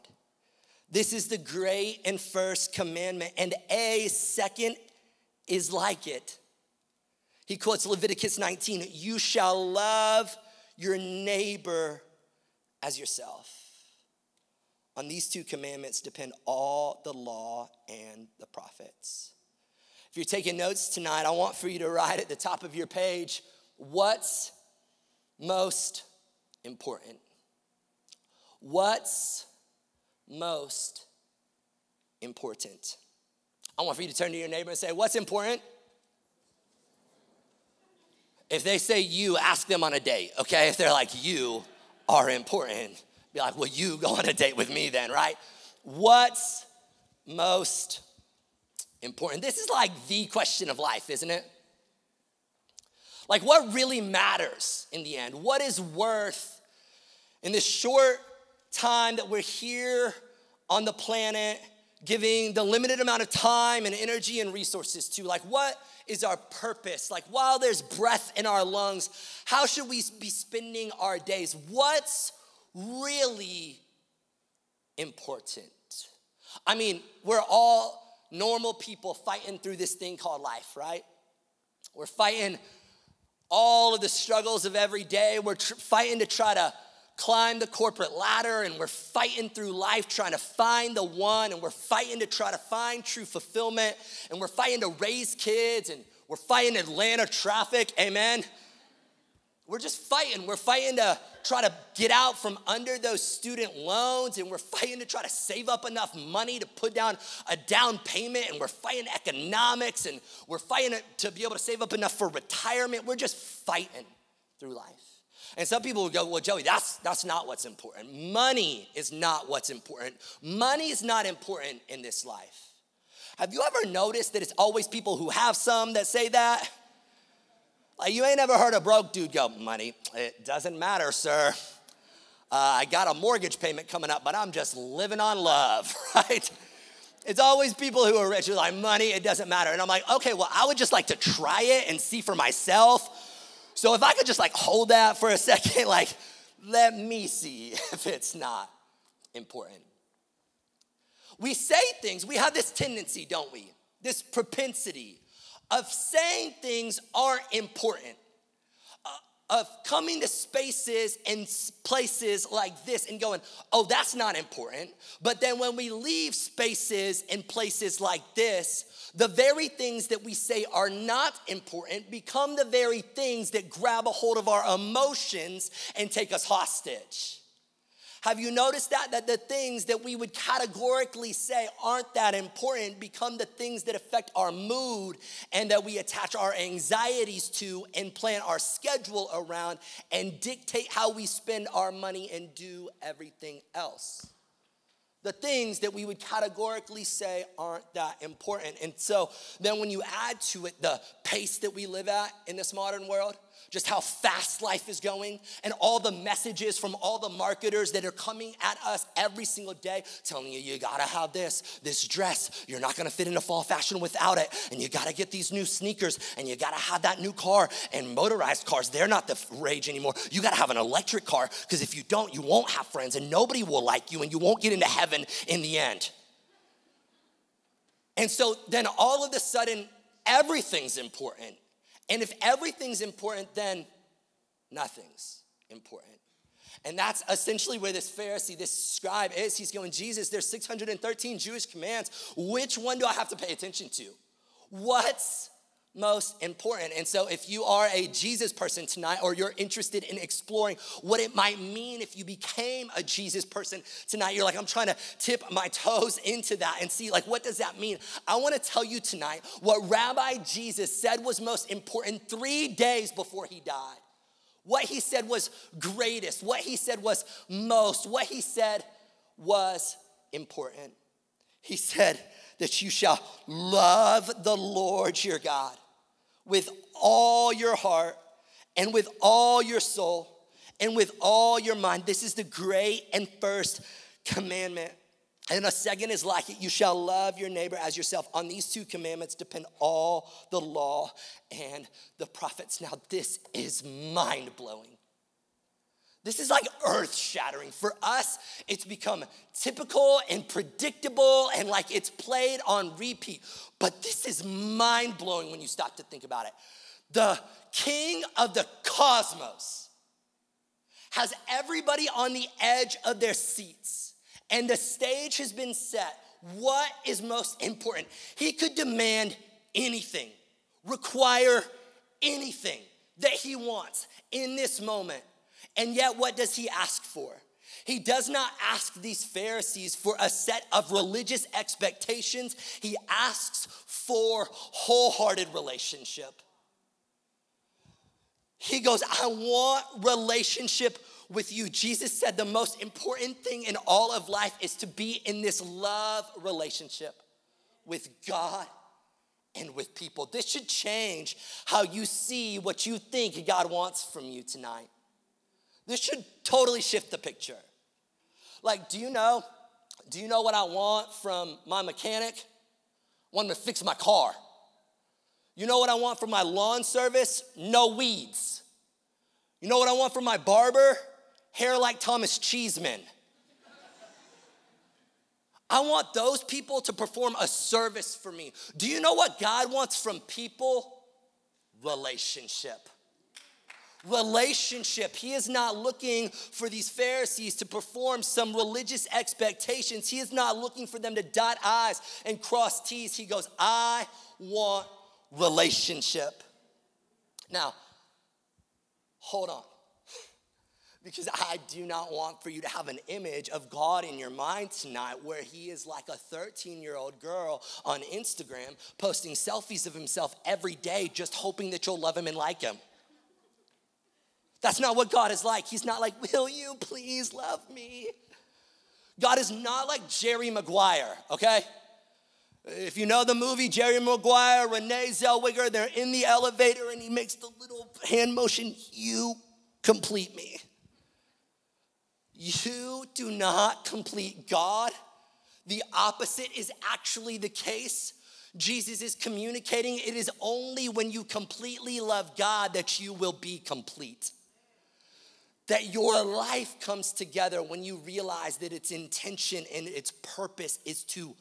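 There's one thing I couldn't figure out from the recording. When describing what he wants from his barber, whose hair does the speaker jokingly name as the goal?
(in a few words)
Thomas Cheeseman.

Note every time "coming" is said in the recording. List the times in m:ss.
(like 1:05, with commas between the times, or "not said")
2:13, 2:39, 3:28.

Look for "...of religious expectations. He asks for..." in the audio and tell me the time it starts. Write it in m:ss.
5:30.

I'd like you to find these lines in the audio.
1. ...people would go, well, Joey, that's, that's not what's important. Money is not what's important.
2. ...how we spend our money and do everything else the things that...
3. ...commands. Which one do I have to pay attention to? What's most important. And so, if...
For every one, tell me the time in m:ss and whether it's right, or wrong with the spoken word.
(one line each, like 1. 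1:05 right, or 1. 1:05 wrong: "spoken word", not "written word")
1. 1:55 right
2. 3:10 right
3. 4:01 right.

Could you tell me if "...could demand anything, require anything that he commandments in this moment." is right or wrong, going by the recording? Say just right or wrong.
wrong.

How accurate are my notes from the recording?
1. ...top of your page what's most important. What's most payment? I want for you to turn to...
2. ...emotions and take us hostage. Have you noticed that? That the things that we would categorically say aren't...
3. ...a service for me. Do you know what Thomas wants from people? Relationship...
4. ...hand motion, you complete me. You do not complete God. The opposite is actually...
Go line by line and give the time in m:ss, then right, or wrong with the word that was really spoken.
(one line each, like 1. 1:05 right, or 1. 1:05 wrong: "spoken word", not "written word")
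1. 0:22 wrong: "important", not "payment"
2. 2:54 right
3. 6:17 wrong: "God", not "Thomas"
4. 7:08 right.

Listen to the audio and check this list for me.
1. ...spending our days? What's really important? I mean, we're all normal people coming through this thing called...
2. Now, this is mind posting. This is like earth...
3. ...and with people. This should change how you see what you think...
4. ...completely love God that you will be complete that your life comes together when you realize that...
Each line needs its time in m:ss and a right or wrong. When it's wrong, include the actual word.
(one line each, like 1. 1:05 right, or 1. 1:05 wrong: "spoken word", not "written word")
1. 1:10 wrong: "fighting", not "coming"
2. 4:52 wrong: "blowing", not "posting"
3. 5:49 right
4. 7:21 right.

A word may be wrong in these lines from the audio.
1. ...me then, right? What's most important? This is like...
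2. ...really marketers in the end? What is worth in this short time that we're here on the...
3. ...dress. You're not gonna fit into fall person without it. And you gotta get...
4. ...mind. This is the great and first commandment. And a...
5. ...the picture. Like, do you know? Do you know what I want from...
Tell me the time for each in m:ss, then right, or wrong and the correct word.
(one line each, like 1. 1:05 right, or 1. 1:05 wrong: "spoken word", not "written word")
1. 0:44 right
2. 0:53 wrong: "matters", not "marketers"
3. 3:32 wrong: "fashion", not "person"
4. 4:41 right
5. 5:57 right.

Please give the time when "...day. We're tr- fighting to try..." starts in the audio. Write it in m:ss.
1:25.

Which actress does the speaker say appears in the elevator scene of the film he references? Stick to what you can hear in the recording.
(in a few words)
Renee Zellweger.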